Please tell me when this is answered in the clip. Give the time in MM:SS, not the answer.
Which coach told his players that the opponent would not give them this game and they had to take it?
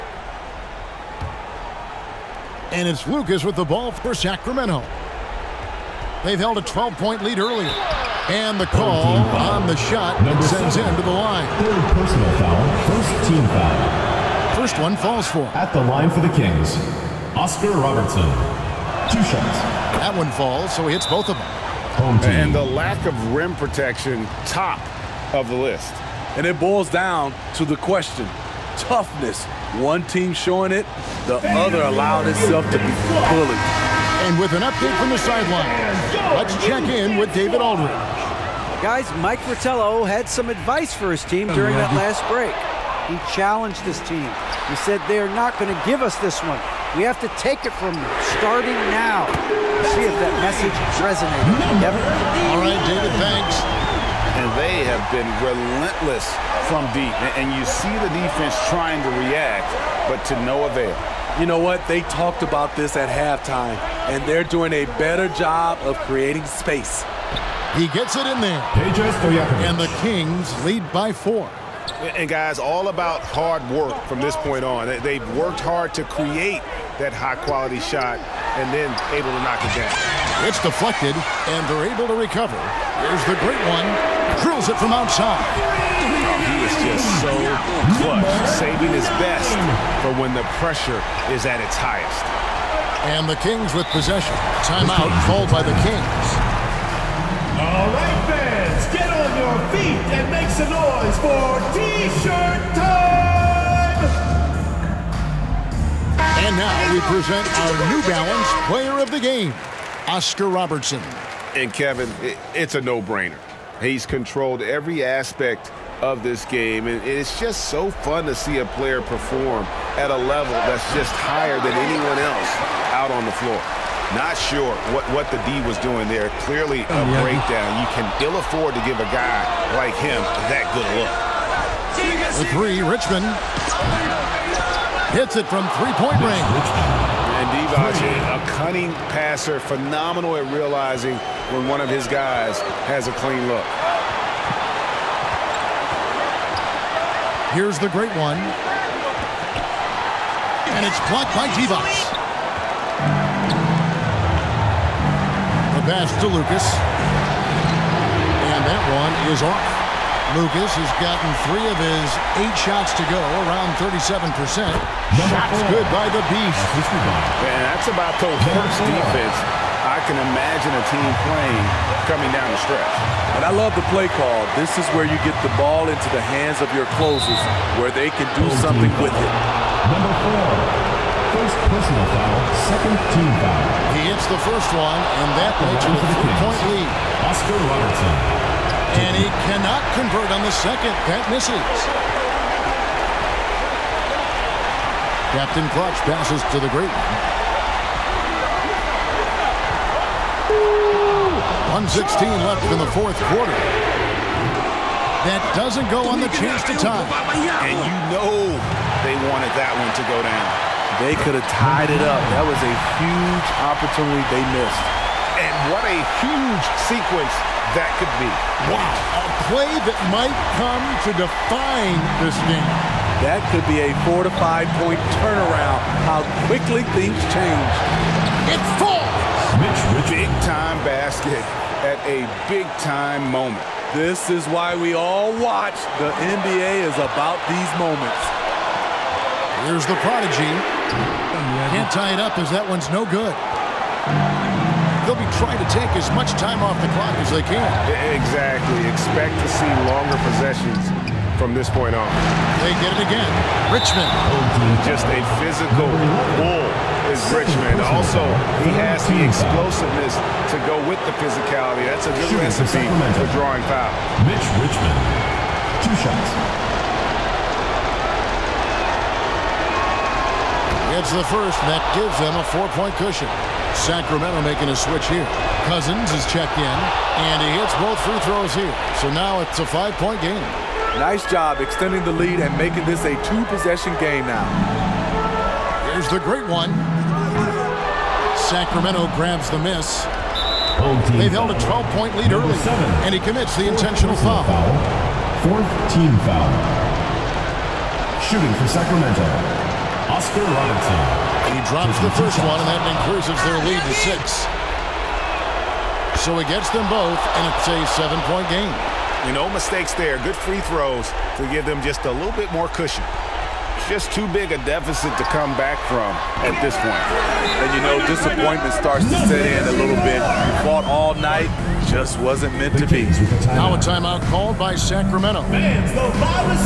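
00:39.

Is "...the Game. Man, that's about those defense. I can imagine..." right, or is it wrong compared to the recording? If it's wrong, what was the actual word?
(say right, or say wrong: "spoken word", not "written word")
wrong: "Beast", not "Game".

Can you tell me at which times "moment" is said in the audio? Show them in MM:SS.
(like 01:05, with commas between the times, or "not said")
03:53, 03:57.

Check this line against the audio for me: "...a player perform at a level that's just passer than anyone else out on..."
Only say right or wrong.
wrong.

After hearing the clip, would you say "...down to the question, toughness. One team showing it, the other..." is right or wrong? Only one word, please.
right.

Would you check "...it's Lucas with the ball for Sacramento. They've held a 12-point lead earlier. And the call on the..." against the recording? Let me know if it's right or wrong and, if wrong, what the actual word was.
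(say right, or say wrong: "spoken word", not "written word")
right.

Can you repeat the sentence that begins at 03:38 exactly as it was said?
Wow, a play that might come to define this game.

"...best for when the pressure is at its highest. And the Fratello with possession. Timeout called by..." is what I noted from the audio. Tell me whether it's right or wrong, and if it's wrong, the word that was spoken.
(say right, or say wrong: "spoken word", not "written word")
wrong: "Kings", not "Fratello".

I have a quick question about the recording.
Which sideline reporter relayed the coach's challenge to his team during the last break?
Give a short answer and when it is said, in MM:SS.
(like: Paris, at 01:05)
David Aldridge, at 00:37.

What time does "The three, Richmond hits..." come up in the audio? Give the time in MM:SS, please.
02:12.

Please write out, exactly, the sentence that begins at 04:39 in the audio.
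So now it's a five-point game.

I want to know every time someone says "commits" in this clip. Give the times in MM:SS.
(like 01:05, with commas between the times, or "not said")
04:53.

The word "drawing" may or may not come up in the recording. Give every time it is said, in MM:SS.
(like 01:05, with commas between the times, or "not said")
04:23.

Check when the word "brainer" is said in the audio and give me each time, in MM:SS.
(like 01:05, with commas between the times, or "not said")
01:52.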